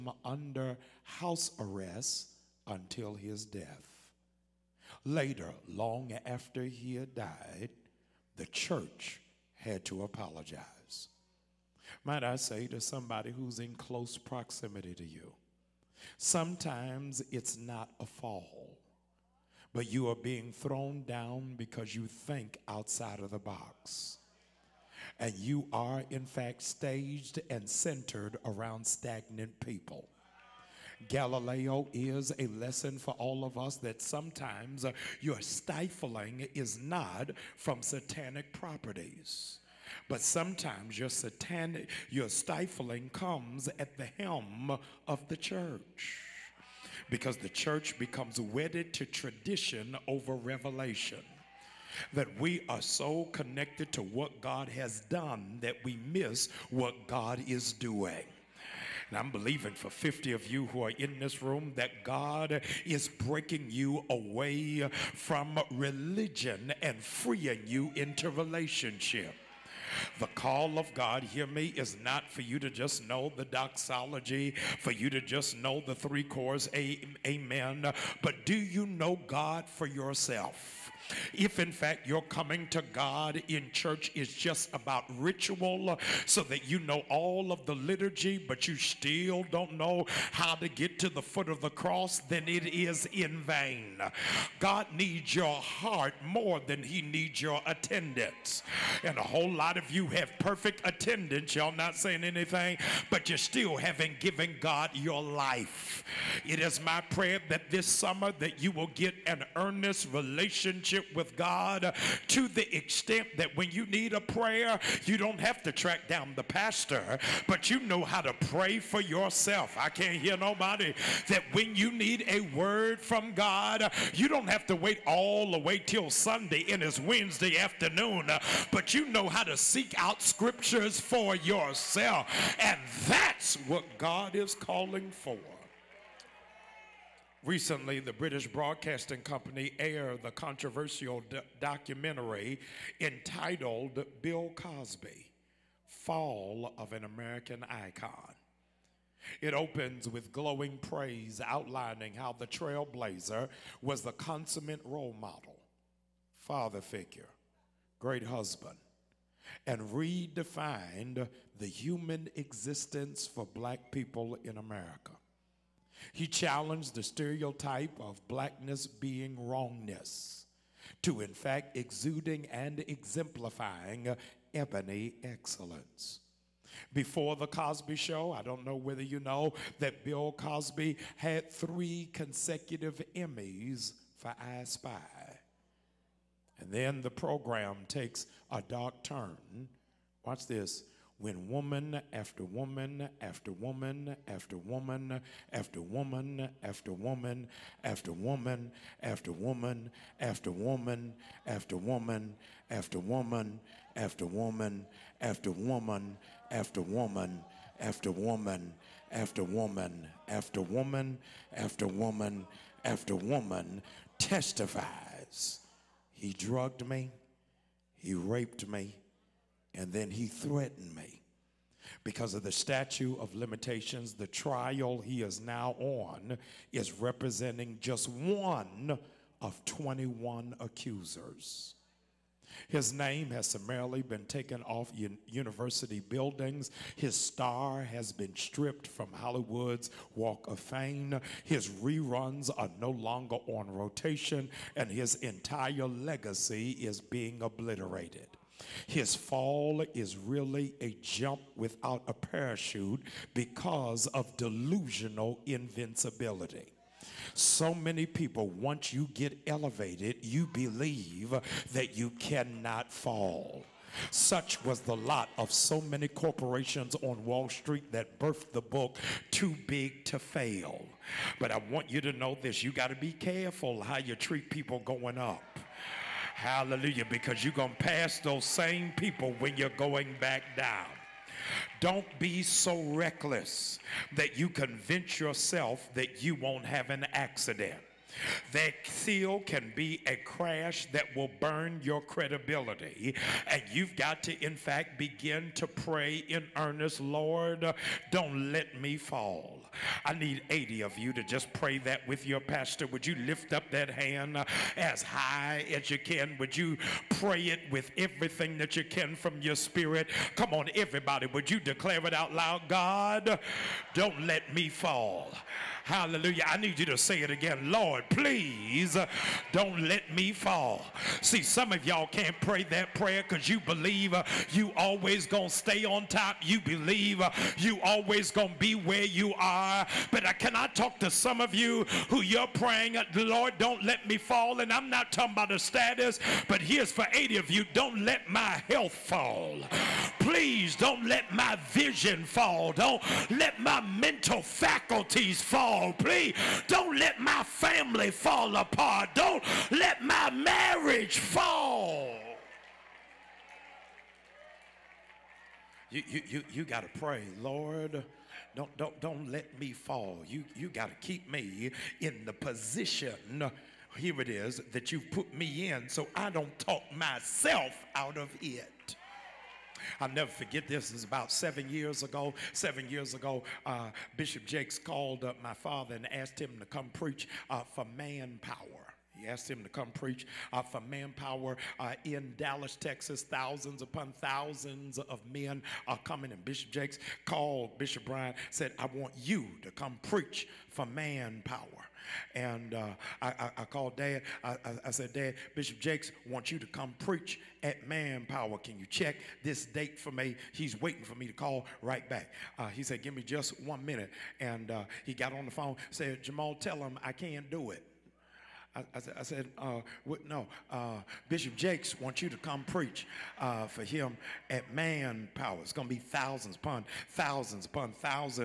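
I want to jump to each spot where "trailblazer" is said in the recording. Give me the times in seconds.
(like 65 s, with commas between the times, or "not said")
152 s.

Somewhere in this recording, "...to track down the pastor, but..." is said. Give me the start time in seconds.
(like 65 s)
115 s.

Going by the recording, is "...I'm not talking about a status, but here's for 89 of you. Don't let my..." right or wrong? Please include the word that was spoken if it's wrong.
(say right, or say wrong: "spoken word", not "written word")
wrong: "80", not "89".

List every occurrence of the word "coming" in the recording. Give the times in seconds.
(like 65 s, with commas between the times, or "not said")
82 s, 386 s.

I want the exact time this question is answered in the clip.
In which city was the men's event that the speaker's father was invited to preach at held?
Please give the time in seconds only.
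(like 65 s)
382 s.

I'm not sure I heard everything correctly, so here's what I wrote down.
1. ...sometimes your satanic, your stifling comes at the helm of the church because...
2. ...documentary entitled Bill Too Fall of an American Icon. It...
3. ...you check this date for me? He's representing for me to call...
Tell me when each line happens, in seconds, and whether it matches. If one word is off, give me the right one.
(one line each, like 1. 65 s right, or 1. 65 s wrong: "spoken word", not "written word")
1. 40 s right
2. 141 s wrong: "Cosby", not "Too"
3. 398 s wrong: "waiting", not "representing".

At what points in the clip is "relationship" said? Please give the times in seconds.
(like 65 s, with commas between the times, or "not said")
68 s, 110 s.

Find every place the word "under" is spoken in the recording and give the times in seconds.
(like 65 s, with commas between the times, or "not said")
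0 s.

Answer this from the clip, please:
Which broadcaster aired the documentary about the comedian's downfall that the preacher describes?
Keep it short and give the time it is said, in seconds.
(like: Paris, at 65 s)
British Broadcasting Company, at 138 s.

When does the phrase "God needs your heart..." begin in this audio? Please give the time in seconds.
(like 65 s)
94 s.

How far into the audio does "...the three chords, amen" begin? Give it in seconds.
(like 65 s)
75 s.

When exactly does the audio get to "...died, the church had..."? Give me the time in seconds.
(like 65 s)
7 s.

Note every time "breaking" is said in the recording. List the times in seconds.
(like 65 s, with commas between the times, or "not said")
63 s.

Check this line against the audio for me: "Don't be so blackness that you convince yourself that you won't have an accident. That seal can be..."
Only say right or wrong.
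wrong.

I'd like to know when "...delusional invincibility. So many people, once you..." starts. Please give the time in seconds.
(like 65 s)
254 s.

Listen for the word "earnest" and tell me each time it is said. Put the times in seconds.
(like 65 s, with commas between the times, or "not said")
109 s, 296 s.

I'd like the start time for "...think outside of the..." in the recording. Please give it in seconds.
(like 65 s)
22 s.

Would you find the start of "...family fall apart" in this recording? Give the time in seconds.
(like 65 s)
347 s.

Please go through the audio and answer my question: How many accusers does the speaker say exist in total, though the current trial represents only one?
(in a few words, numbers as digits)
21.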